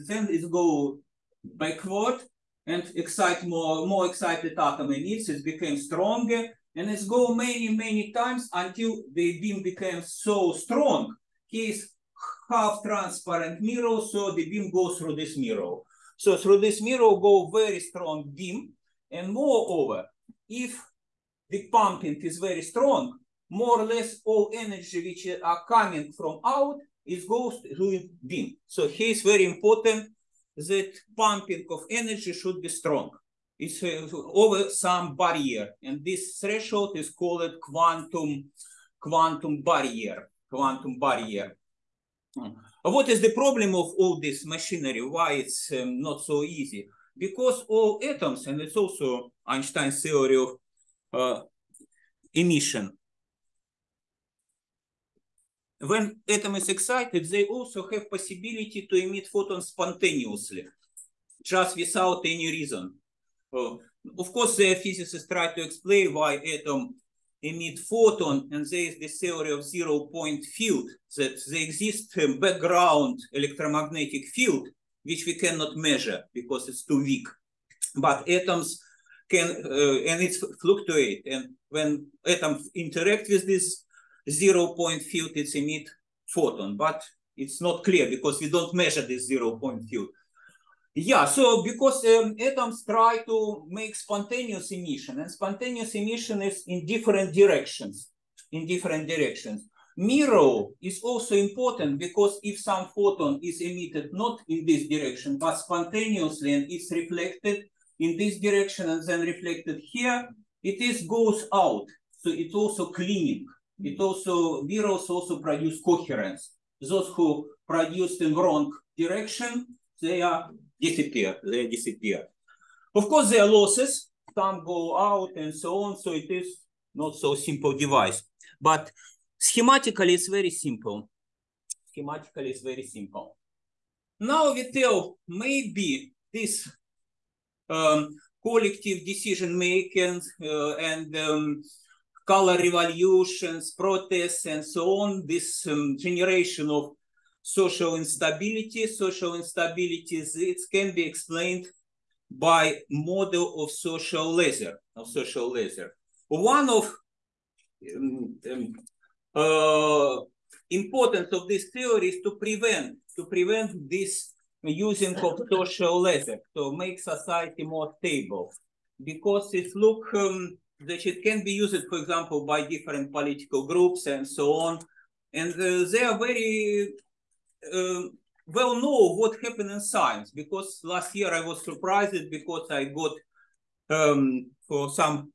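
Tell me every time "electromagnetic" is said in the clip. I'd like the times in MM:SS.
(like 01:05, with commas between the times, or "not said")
01:13.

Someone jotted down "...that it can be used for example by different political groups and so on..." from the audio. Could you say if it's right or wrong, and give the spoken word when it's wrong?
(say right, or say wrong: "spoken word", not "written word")
right.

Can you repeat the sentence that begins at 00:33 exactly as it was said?
It's uh, over some barrier, and this threshold is called quantum quantum barrier.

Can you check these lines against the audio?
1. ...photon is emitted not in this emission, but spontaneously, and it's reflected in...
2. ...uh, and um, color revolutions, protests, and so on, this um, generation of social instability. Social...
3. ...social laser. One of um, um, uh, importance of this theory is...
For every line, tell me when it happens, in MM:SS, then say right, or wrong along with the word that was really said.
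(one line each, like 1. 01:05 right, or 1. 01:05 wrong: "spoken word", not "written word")
1. 01:42 wrong: "direction", not "emission"
2. 02:20 right
3. 02:35 right.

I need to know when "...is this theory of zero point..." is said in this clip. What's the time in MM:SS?
01:08.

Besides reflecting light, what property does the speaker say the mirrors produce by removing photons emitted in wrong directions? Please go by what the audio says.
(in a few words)
coherence.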